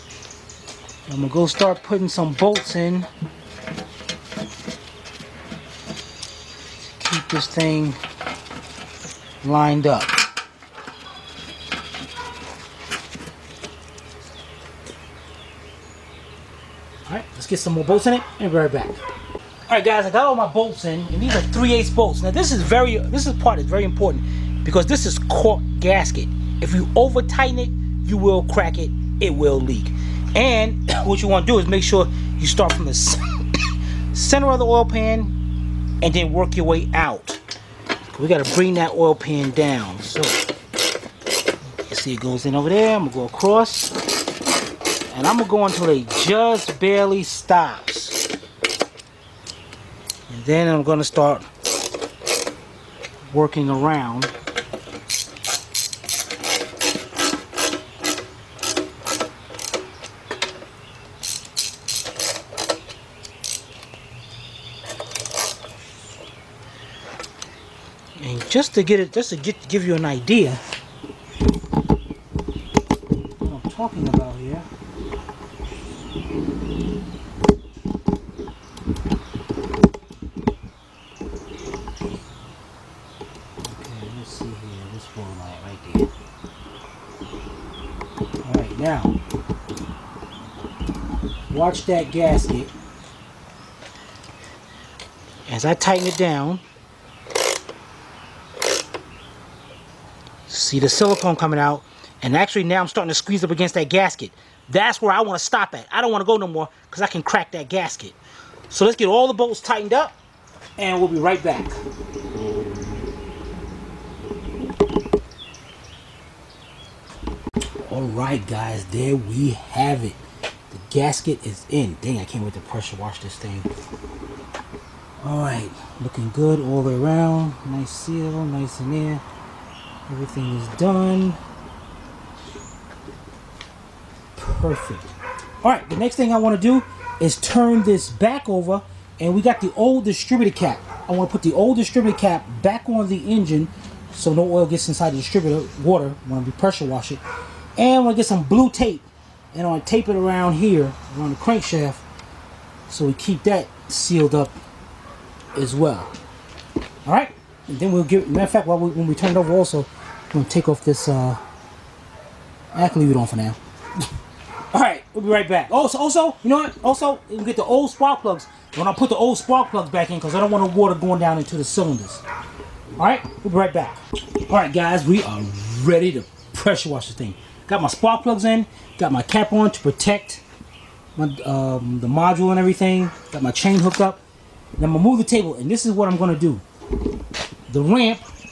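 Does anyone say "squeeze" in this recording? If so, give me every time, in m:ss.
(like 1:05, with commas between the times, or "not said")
1:43.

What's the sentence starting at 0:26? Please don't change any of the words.
If you over tighten it, you will crack it, it will leak.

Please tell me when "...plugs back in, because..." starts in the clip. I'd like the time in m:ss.
2:49.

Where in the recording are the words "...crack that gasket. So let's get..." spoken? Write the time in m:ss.
1:47.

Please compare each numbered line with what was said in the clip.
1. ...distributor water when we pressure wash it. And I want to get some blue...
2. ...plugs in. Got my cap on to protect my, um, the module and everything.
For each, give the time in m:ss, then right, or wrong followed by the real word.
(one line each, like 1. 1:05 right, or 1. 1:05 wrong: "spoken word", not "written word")
1. 2:25 right
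2. 2:58 right.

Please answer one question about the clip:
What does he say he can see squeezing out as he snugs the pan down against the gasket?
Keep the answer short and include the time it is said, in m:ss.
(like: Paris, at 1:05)
silicone, at 1:40.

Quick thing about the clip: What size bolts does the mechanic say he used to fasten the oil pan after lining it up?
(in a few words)
3/8.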